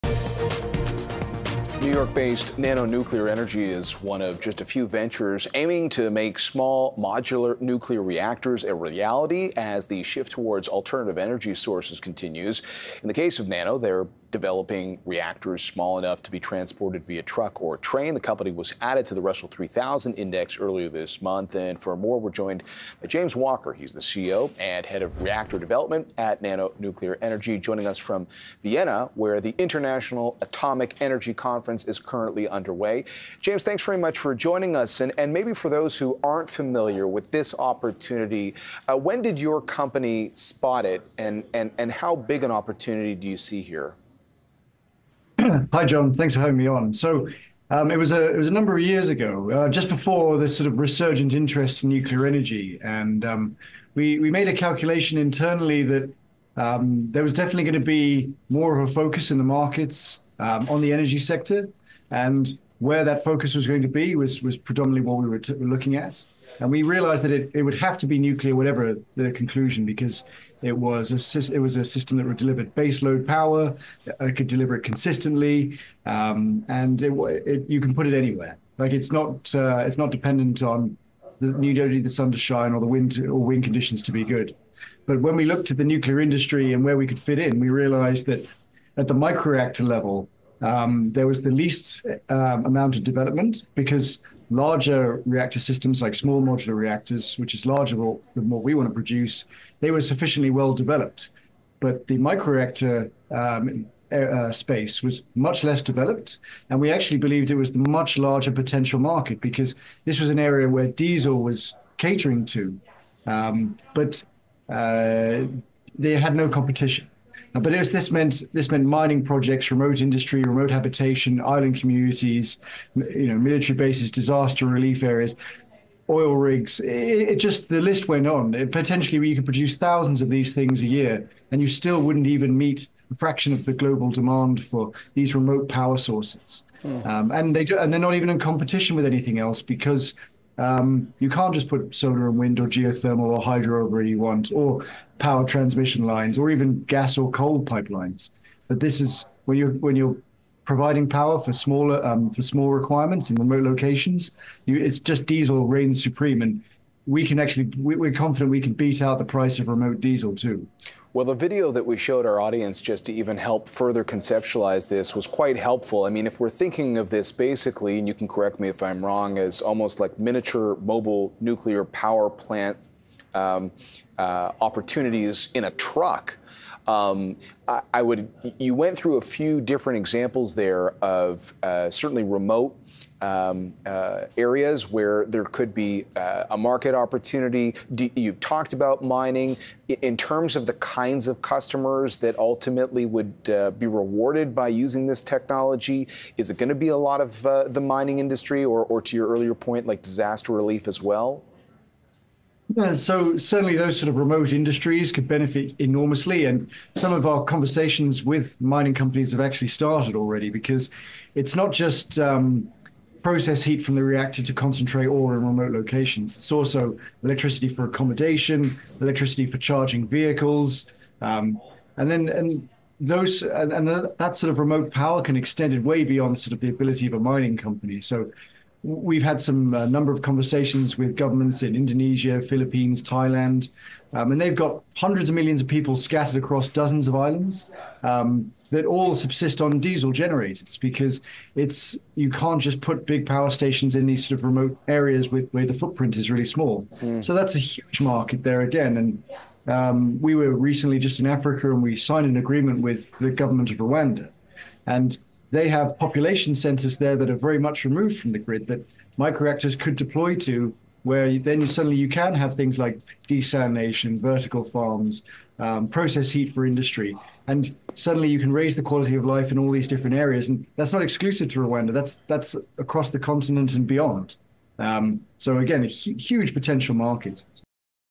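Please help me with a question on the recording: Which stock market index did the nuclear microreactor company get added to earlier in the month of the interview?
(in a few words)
Russell 3000.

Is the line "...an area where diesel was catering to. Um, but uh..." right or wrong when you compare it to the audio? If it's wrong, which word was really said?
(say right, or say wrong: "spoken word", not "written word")
right.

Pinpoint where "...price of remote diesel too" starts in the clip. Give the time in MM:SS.
02:39.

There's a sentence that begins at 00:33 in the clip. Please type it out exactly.
James, thanks very much for joining us.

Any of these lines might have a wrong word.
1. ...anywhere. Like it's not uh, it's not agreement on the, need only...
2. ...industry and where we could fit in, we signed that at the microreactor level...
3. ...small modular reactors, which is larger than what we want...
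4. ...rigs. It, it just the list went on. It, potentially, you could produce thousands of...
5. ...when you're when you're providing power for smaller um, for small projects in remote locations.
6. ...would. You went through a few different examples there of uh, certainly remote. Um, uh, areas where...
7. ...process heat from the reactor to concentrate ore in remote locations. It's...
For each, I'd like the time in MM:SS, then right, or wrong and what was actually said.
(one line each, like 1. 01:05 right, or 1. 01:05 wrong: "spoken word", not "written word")
1. 01:18 wrong: "dependent", not "agreement"
2. 01:26 wrong: "realized", not "signed"
3. 01:36 right
4. 02:06 right
5. 02:29 wrong: "requirements", not "projects"
6. 02:58 right
7. 03:33 right.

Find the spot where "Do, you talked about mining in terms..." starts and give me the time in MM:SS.
03:07.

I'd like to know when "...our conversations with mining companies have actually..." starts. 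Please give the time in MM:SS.
03:27.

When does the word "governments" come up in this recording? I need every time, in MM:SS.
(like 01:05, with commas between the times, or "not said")
03:51, 04:13.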